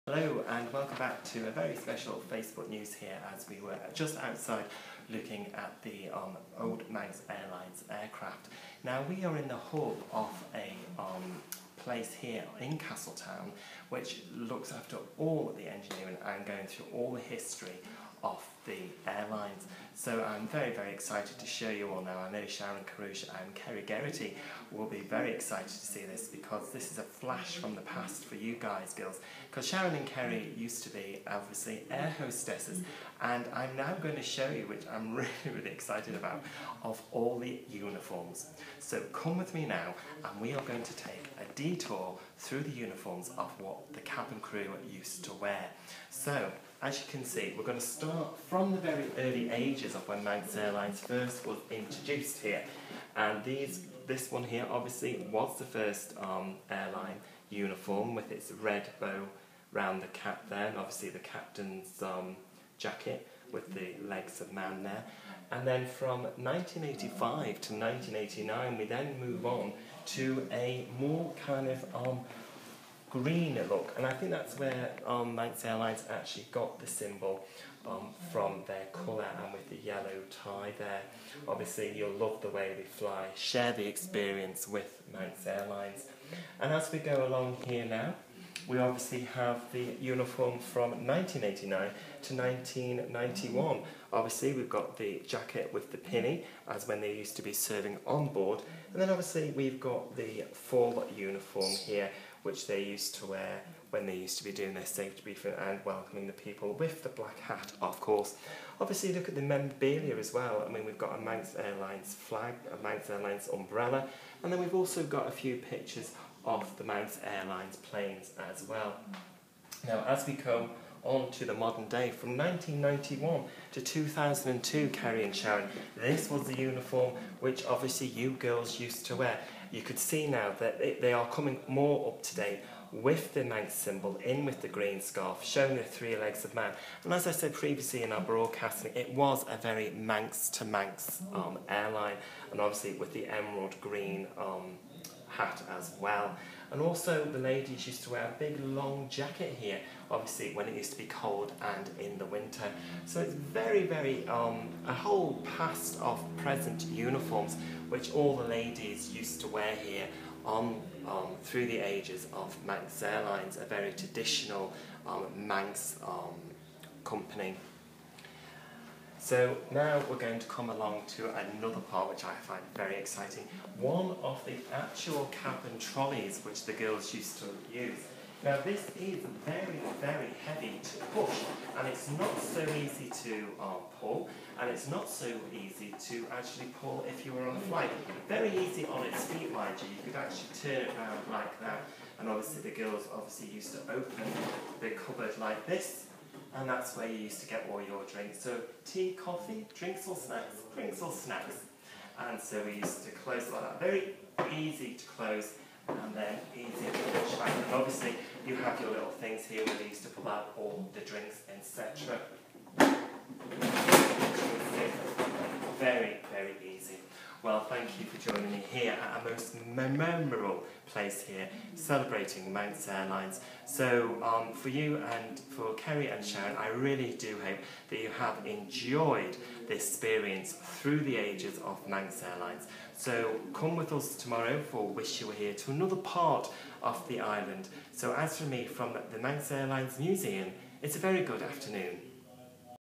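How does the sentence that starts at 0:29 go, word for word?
Because Sharon and Kerry used to be, obviously, air hostesses.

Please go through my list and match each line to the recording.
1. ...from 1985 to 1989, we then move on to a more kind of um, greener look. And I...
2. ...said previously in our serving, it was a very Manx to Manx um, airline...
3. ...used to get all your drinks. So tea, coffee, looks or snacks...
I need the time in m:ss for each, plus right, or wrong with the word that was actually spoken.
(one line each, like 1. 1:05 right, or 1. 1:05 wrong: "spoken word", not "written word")
1. 1:05 right
2. 2:17 wrong: "broadcasting", not "serving"
3. 3:17 wrong: "drinks", not "looks".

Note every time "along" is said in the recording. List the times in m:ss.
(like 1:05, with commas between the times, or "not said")
1:27, 2:50.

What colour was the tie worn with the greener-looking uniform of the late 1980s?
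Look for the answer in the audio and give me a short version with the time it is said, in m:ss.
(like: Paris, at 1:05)
Yellow, at 1:19.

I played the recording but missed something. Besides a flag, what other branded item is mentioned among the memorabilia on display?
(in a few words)
Umbrella.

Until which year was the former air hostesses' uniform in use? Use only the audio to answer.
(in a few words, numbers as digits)
2002.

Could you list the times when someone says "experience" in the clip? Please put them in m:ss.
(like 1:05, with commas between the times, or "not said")
1:23, 3:49.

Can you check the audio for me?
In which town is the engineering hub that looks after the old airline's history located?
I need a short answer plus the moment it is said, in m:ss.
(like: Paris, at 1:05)
Castletown, at 0:12.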